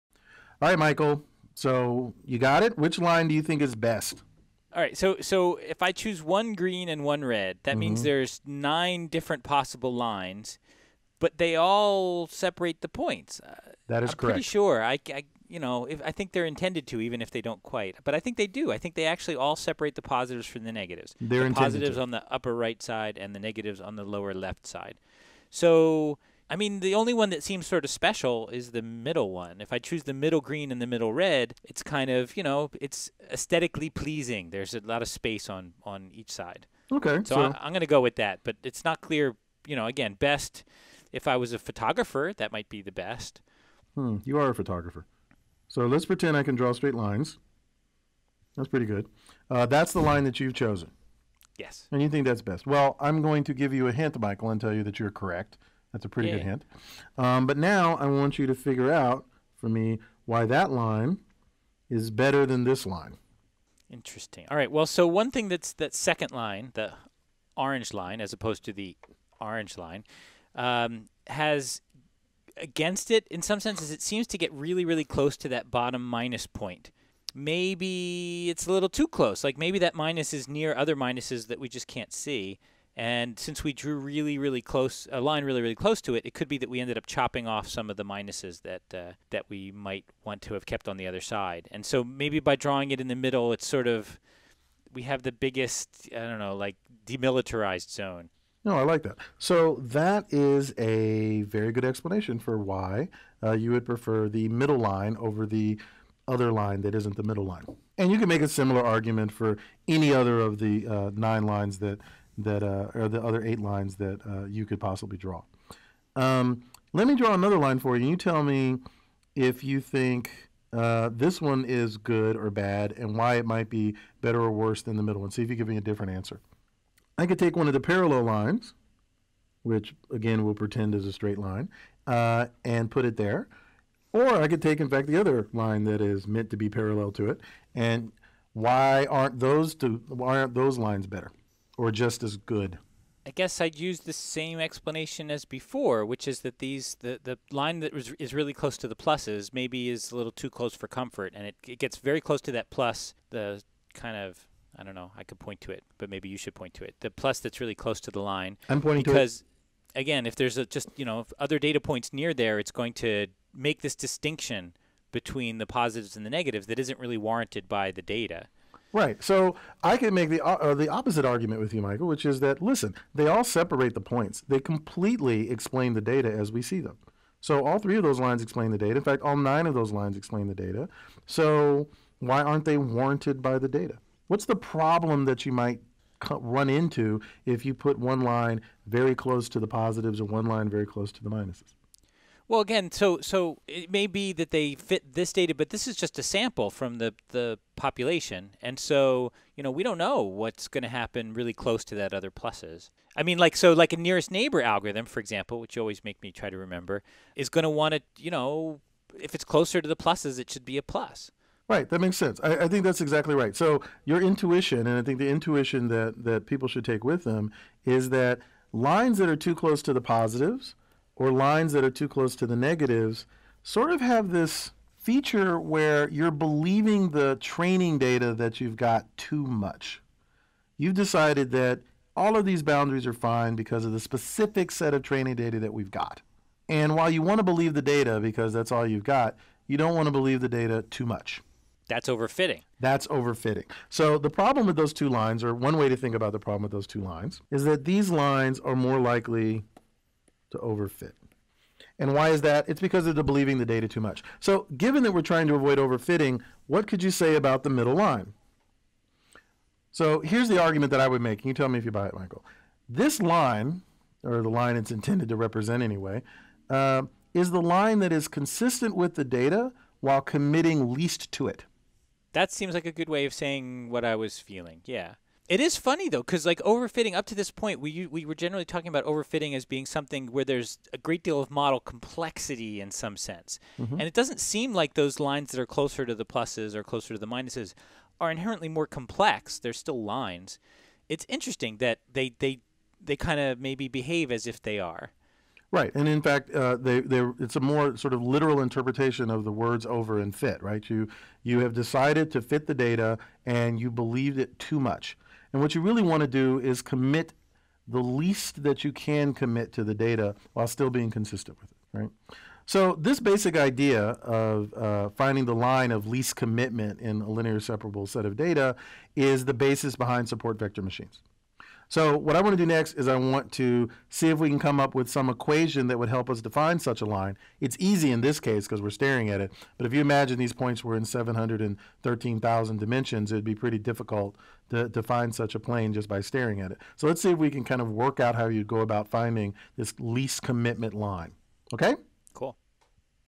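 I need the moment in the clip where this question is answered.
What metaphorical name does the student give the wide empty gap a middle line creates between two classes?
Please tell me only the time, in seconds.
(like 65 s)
97 s.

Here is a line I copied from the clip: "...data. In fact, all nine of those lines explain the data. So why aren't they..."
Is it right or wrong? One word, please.
right.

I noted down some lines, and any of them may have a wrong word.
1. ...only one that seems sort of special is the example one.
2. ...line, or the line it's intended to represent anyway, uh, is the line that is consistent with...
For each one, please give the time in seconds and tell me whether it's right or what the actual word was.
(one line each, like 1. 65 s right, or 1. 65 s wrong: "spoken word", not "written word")
1. 26 s wrong: "middle", not "example"
2. 263 s right.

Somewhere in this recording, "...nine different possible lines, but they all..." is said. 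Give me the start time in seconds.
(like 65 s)
8 s.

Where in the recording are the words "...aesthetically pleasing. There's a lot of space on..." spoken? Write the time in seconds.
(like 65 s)
33 s.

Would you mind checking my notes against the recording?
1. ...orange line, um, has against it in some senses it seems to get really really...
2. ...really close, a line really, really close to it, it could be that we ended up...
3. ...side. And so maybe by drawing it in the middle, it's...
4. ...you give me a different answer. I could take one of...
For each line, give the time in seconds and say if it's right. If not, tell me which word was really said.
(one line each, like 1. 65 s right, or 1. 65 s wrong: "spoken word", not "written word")
1. 69 s right
2. 84 s right
3. 91 s right
4. 125 s right.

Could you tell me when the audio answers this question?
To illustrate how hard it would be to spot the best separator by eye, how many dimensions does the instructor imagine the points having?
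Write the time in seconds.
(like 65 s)
331 s.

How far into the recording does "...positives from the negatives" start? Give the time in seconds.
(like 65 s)
20 s.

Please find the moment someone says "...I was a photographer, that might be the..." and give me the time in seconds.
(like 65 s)
41 s.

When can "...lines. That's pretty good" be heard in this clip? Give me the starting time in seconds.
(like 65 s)
46 s.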